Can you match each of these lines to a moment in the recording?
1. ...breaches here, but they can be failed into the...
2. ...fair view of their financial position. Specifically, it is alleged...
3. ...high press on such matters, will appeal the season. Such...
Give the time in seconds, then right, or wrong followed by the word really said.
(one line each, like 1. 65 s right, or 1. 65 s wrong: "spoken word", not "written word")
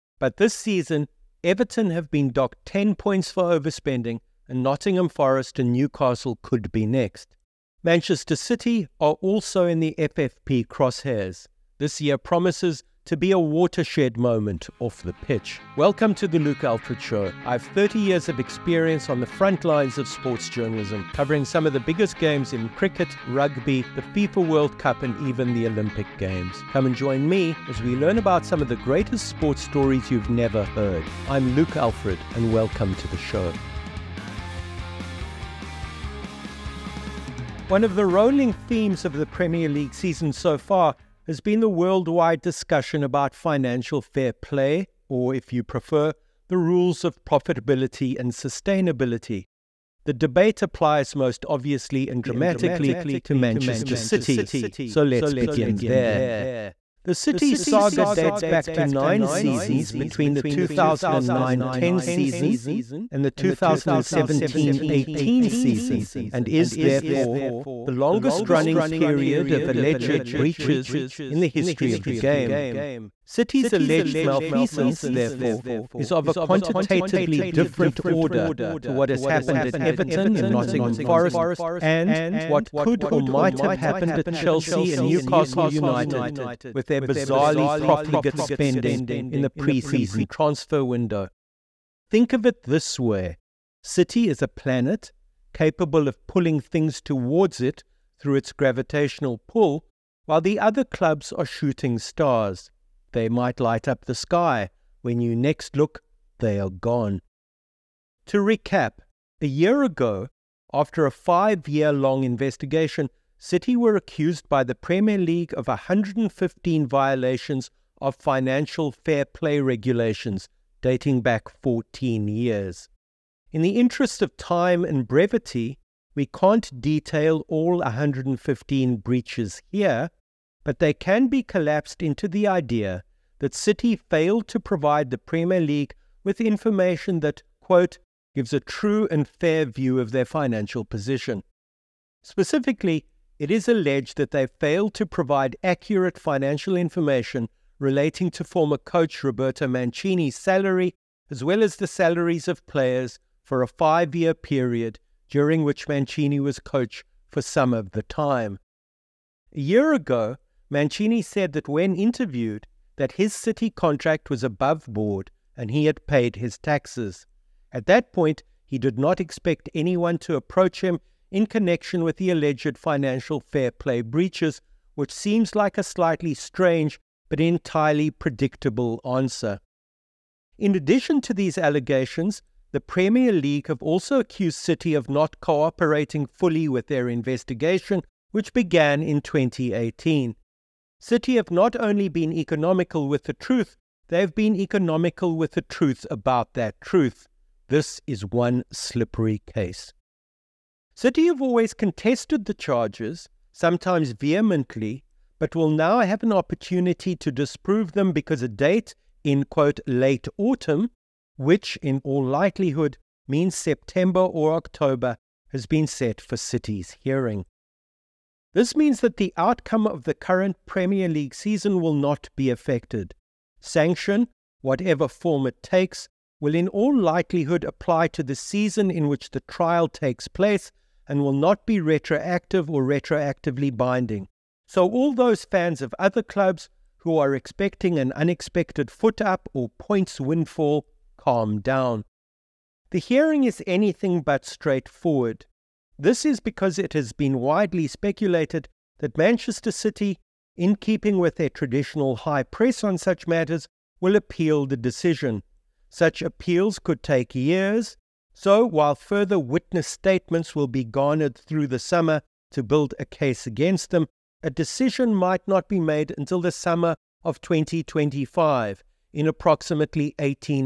1. 128 s wrong: "collapsed", not "failed"
2. 139 s right
3. 252 s wrong: "decision", not "season".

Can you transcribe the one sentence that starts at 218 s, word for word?
This means that the outcome of the current Premier League season will not be affected.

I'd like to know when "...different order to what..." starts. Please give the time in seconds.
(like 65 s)
77 s.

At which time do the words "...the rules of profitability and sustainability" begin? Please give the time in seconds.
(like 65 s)
46 s.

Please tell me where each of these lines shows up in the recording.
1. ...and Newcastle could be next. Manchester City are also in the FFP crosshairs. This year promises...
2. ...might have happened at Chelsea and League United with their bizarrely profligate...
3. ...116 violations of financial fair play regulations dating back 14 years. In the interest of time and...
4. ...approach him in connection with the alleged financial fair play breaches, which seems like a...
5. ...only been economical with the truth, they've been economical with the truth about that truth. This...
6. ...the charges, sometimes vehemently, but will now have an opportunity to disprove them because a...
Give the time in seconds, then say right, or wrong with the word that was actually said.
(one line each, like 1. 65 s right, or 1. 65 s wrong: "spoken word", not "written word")
1. 5 s right
2. 83 s wrong: "Newcastle", not "League"
3. 115 s wrong: "115", not "116"
4. 170 s right
5. 191 s right
6. 202 s right.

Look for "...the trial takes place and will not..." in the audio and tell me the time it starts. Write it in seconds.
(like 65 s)
229 s.